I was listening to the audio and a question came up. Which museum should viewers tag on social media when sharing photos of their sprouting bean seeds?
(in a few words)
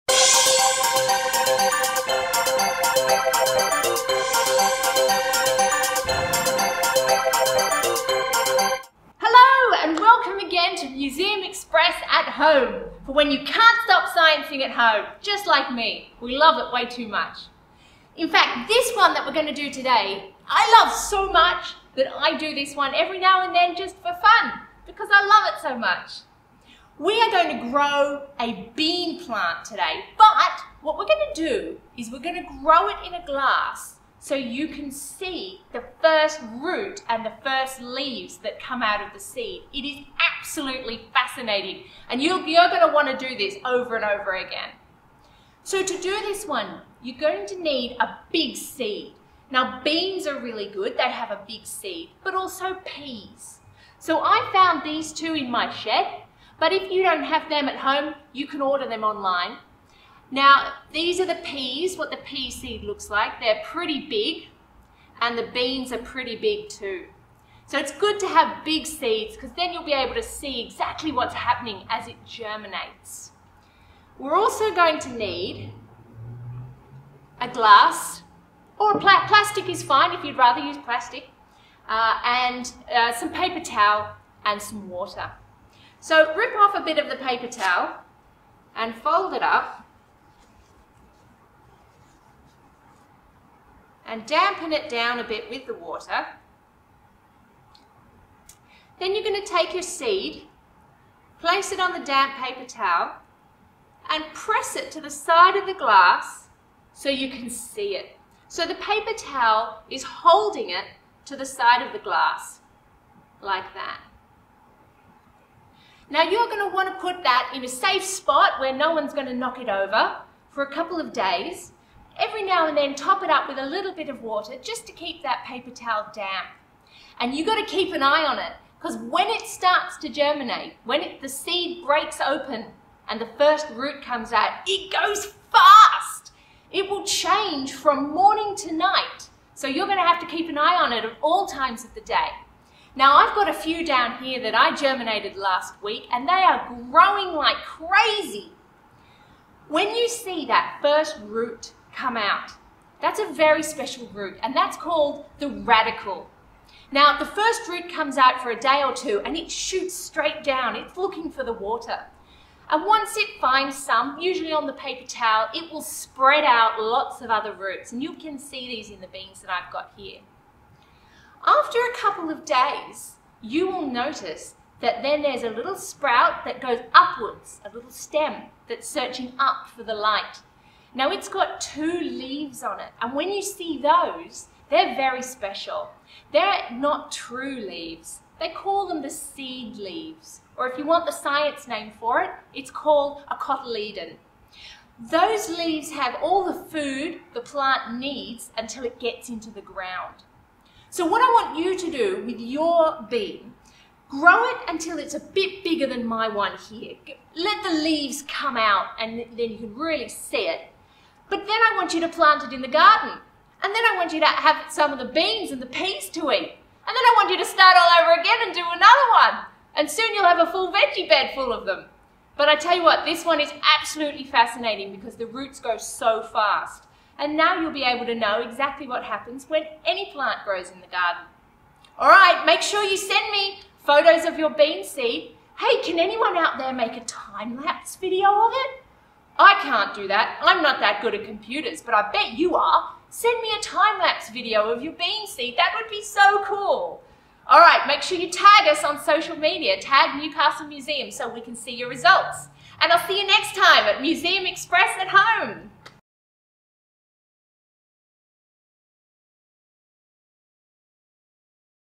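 Newcastle Museum.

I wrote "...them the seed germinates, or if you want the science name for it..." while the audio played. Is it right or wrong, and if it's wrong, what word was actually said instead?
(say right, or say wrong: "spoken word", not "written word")
wrong: "leaves", not "germinates".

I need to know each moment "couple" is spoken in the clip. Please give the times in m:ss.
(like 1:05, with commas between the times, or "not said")
2:00, 2:51.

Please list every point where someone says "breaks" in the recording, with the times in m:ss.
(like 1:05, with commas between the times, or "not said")
2:11.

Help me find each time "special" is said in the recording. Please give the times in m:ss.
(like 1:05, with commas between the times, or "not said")
2:33, 3:05.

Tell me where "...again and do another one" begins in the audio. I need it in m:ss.
3:38.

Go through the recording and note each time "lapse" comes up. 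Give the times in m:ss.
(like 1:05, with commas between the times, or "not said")
3:57, 4:03.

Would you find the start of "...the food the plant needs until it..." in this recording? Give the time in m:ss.
3:16.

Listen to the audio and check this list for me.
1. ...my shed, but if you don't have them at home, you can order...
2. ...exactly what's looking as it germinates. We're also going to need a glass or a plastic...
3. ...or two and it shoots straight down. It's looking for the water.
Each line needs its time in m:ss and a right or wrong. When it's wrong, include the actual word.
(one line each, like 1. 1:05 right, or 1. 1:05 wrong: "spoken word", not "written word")
1. 0:55 right
2. 1:10 wrong: "happening", not "looking"
3. 2:38 right.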